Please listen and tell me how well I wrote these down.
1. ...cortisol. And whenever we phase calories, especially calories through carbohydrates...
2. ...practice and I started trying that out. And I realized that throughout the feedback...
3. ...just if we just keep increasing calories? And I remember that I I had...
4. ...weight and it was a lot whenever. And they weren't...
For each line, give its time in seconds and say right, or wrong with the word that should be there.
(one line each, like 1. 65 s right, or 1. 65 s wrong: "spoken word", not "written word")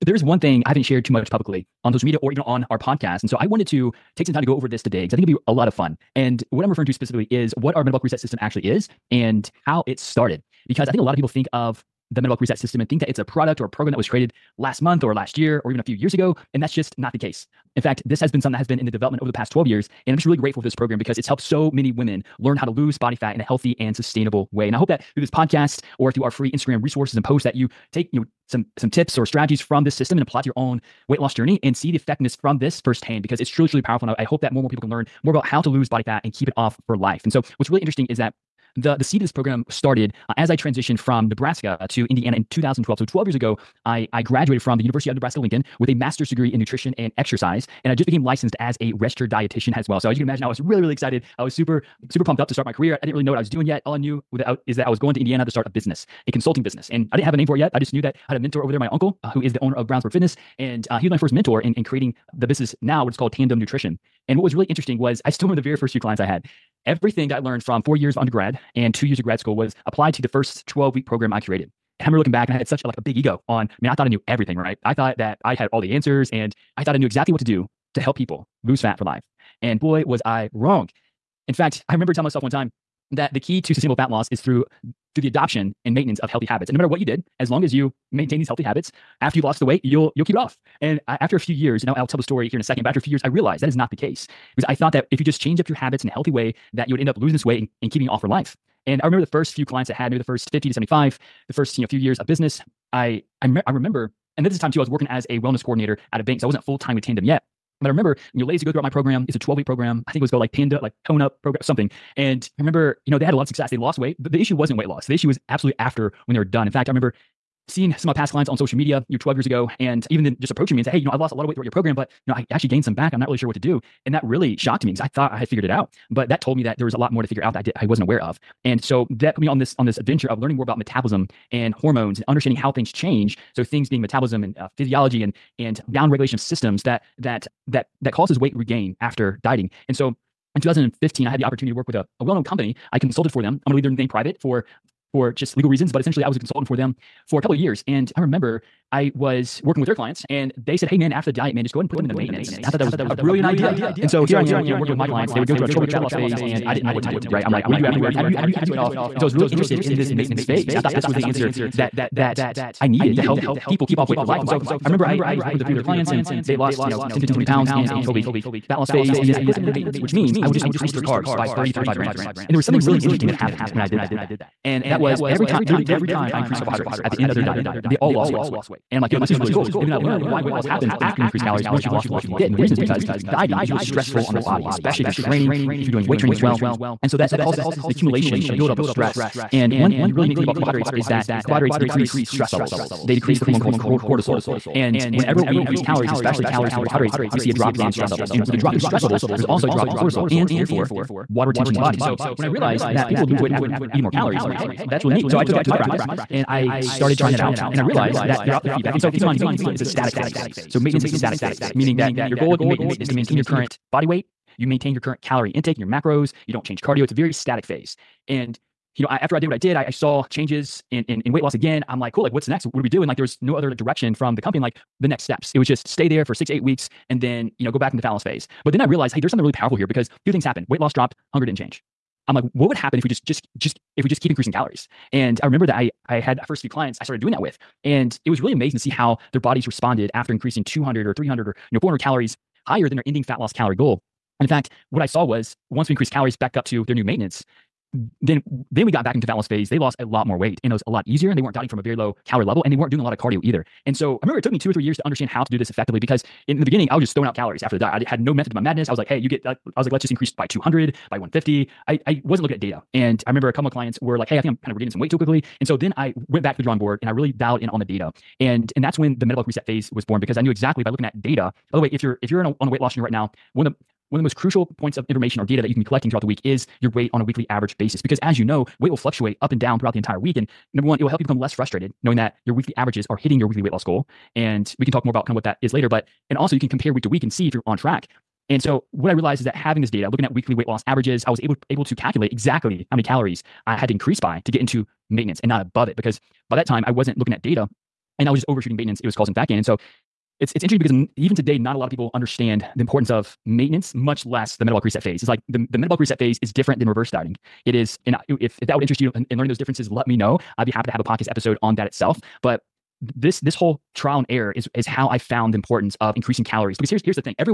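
1. 193 s wrong: "increase", not "phase"
2. 205 s right
3. 233 s right
4. 250 s wrong: "easier", not "whenever".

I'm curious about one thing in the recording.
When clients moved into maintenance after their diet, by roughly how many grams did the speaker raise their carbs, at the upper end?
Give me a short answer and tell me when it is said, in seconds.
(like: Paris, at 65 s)
35 grams, at 171 s.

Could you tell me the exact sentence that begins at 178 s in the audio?
And I'm like, yo, this is really cool.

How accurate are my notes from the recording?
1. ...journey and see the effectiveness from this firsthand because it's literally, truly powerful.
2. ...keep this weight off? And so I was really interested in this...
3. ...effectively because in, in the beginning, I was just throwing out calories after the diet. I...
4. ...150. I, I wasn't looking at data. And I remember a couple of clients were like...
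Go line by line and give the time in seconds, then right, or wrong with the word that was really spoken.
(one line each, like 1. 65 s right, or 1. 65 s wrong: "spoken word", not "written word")
1. 31 s wrong: "truly", not "literally"
2. 158 s right
3. 255 s right
4. 261 s right.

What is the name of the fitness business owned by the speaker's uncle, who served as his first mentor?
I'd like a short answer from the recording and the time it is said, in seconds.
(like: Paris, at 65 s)
Brownsburg Fitness, at 59 s.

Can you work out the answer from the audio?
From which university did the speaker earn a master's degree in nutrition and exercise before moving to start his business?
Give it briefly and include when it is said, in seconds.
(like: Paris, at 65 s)
University of Nebraska Lincoln, at 44 s.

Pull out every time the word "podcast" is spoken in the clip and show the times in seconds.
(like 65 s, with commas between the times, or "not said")
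2 s, 25 s, 311 s.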